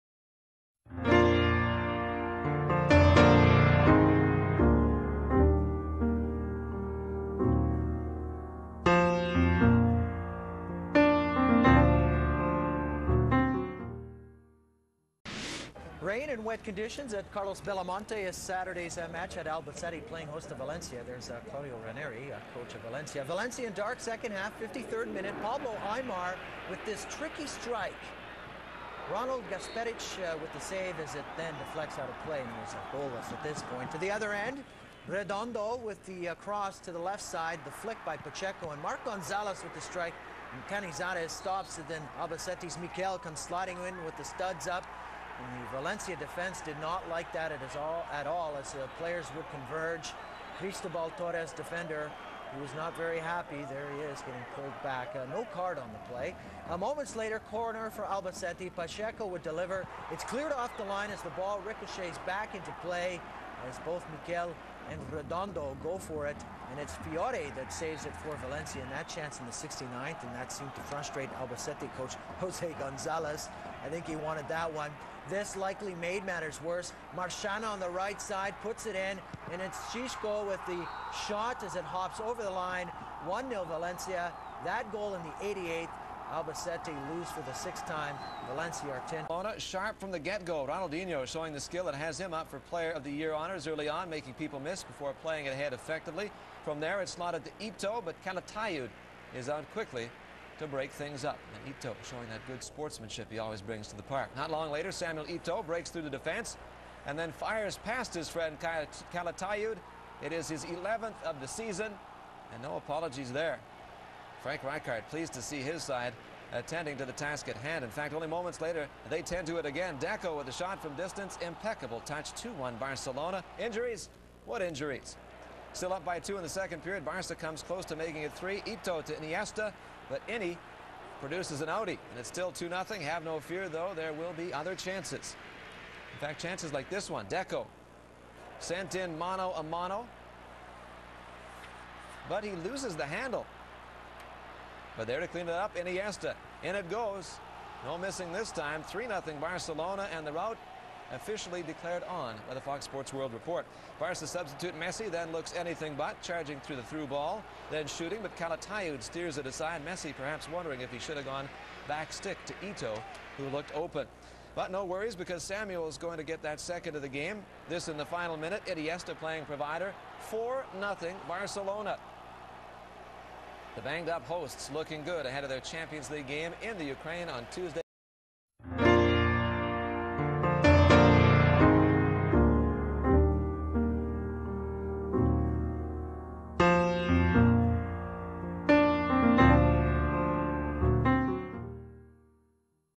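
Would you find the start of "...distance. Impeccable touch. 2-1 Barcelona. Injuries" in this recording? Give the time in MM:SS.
02:00.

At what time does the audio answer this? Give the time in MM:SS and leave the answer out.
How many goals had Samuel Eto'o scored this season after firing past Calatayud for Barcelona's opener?
01:50.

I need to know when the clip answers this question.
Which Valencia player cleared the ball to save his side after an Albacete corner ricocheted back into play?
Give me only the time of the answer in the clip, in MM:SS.
01:06.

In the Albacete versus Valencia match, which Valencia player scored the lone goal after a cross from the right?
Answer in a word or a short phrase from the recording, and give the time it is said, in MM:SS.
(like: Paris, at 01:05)
Xisco, at 01:19.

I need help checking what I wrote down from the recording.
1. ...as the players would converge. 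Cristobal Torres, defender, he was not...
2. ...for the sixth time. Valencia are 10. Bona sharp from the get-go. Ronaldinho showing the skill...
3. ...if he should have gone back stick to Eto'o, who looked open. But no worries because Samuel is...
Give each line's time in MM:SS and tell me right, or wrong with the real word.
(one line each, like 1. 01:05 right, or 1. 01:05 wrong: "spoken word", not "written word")
1. 00:48 right
2. 01:27 right
3. 02:40 right.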